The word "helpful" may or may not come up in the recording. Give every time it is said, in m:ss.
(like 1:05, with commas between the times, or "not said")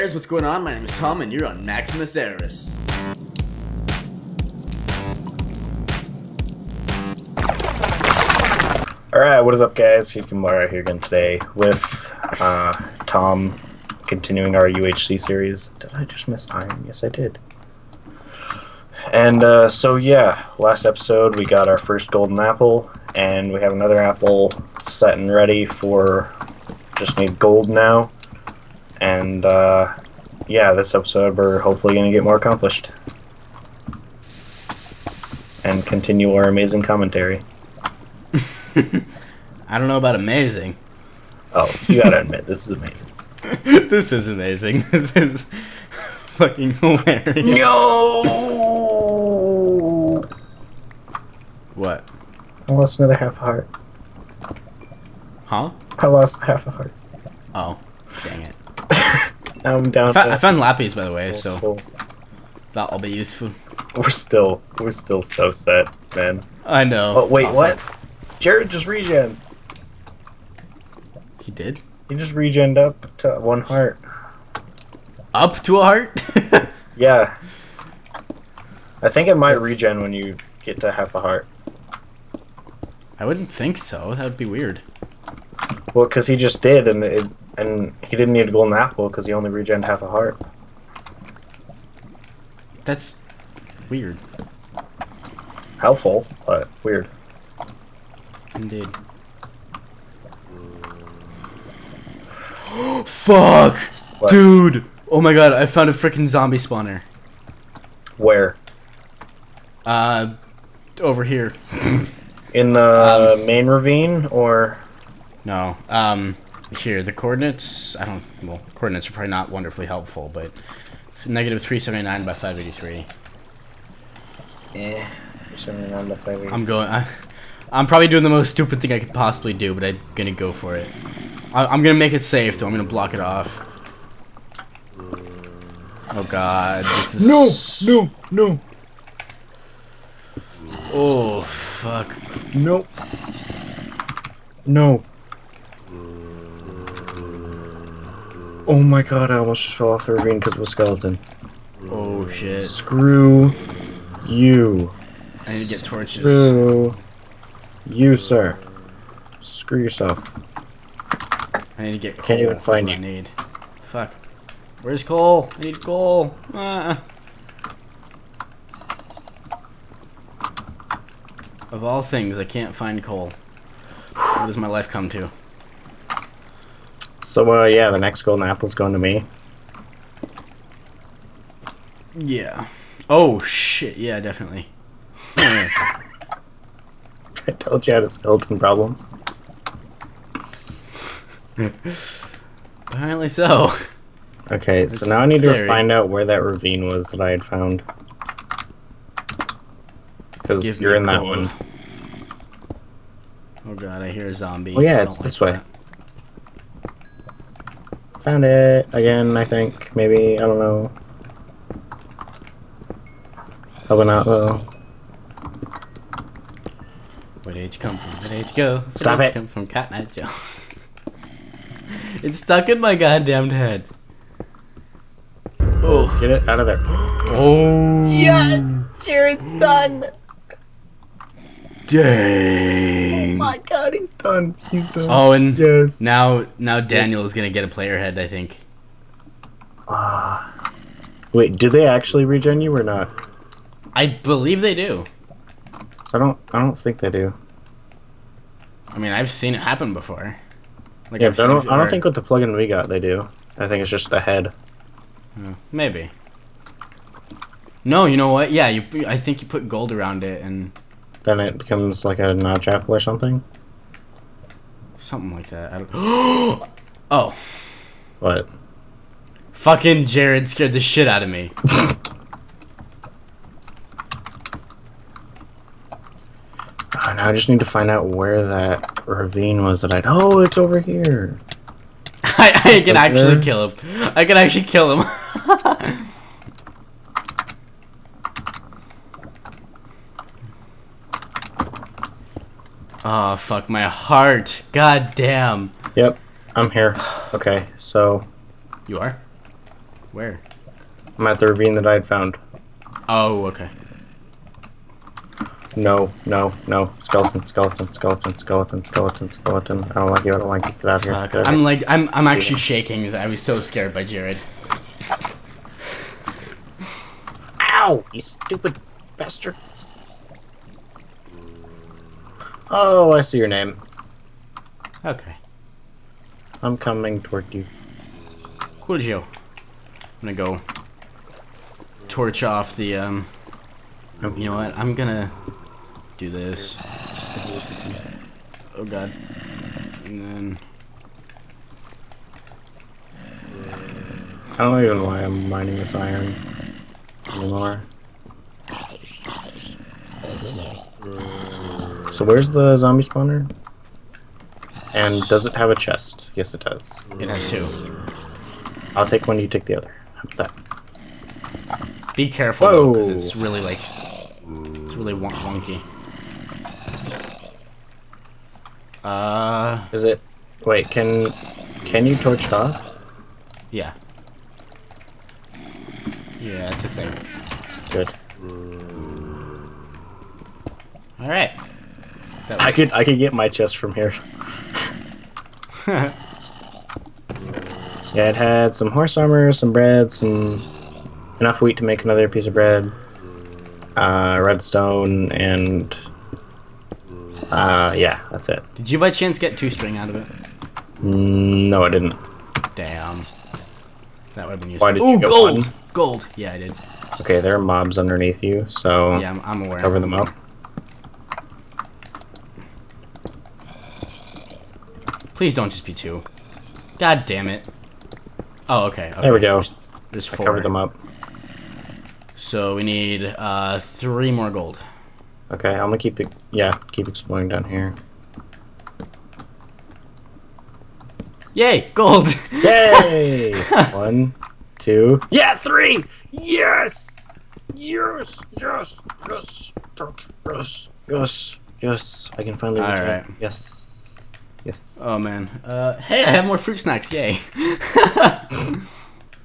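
1:35, 1:59.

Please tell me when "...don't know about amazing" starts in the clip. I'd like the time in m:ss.
0:39.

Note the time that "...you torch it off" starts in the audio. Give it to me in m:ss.
6:12.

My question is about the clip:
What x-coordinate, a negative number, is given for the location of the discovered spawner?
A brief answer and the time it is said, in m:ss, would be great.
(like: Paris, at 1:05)
-379, at 2:01.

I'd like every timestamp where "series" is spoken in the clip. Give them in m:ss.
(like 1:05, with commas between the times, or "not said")
0:15.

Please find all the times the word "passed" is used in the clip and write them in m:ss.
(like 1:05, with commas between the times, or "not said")
not said.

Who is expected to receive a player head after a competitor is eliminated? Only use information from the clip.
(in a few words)
Daniel.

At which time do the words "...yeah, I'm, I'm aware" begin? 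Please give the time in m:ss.
6:49.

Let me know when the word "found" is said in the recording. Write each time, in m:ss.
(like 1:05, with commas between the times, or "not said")
1:00, 1:45, 3:17, 3:28, 5:02.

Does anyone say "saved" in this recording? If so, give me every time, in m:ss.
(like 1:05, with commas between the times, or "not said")
not said.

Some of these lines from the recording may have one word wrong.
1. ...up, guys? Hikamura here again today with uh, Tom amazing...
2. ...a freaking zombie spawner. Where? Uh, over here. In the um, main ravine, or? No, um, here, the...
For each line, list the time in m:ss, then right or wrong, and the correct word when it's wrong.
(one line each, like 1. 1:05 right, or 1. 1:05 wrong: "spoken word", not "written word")
1. 0:09 wrong: "continuing", not "amazing"
2. 1:45 right.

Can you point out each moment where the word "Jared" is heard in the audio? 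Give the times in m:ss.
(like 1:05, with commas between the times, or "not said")
1:08, 3:48, 4:30, 5:14.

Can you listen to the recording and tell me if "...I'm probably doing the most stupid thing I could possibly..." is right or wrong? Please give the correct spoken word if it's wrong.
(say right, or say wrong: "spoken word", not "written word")
right.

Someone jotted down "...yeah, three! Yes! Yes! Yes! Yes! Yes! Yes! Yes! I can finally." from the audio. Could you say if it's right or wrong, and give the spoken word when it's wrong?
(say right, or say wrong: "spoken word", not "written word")
right.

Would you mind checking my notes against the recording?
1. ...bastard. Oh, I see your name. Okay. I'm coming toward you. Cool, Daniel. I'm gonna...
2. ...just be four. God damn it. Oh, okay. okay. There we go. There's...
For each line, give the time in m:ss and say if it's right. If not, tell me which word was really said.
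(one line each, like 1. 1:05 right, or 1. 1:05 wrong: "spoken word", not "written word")
1. 5:19 wrong: "Joe", not "Daniel"
2. 6:55 wrong: "two", not "four".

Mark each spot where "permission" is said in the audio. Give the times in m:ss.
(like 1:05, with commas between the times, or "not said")
not said.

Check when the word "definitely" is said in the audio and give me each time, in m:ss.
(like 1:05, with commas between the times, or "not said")
3:04.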